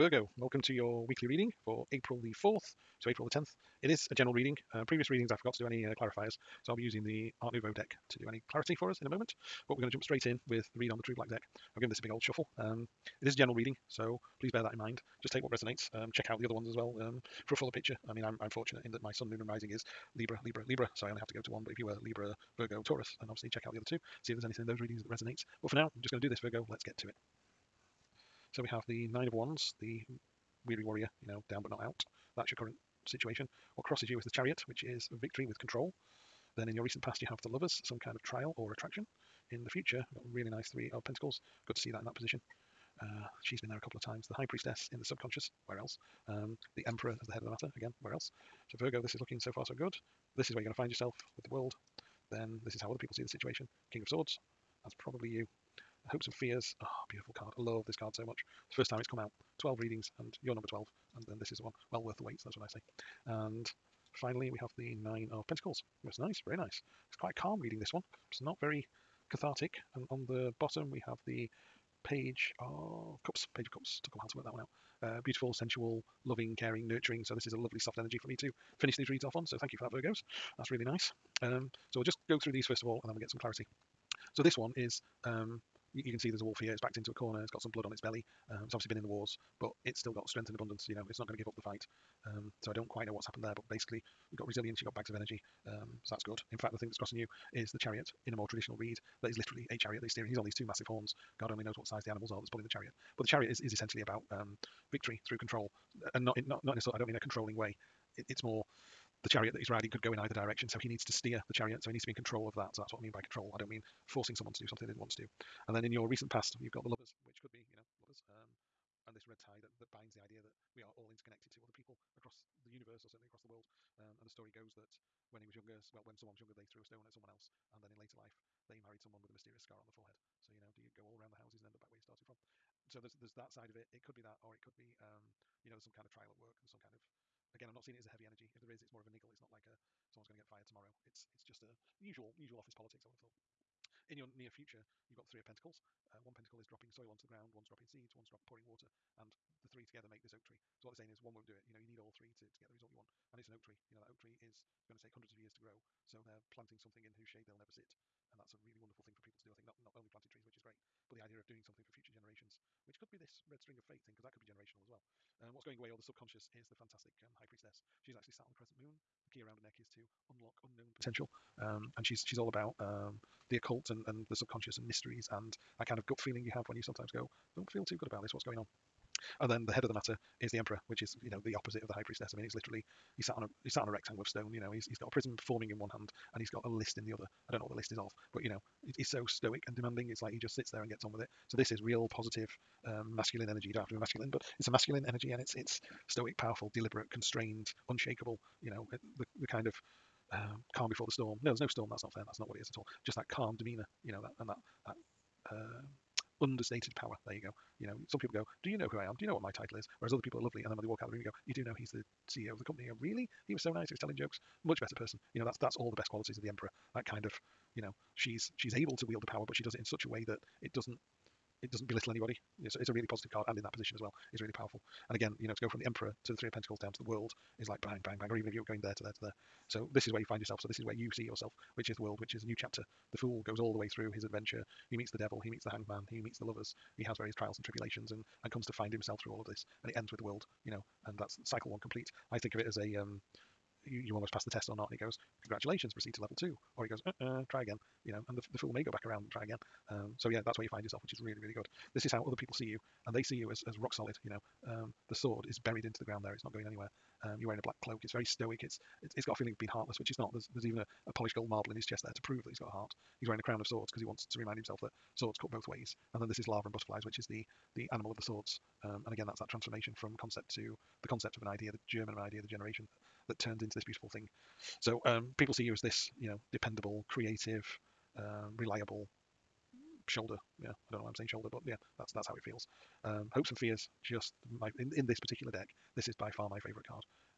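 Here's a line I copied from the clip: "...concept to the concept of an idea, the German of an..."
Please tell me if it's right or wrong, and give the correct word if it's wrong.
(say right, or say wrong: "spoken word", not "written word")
right.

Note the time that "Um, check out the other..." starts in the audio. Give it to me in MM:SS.
00:15.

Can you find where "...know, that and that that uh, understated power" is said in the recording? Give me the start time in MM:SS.
03:24.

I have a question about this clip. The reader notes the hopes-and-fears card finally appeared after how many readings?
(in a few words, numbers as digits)
12.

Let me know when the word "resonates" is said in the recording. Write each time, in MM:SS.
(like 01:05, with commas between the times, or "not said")
00:15, 00:25.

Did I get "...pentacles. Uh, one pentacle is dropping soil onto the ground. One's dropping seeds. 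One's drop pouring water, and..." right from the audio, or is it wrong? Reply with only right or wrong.
right.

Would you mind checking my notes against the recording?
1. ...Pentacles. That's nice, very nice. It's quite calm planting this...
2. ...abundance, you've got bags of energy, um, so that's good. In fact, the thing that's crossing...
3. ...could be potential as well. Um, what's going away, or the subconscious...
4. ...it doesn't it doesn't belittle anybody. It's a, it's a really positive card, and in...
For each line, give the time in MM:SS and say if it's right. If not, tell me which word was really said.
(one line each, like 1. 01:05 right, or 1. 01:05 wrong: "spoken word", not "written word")
1. 01:05 wrong: "reading", not "planting"
2. 01:34 wrong: "resilience", not "abundance"
3. 02:44 wrong: "generational", not "potential"
4. 03:40 right.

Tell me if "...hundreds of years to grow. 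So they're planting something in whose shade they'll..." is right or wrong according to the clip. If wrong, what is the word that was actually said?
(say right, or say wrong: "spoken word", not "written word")
right.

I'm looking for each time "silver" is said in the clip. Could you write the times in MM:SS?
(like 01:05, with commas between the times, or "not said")
not said.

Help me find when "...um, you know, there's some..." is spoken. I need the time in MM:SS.
02:14.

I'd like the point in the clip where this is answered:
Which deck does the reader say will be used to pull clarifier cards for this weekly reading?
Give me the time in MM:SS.
00:07.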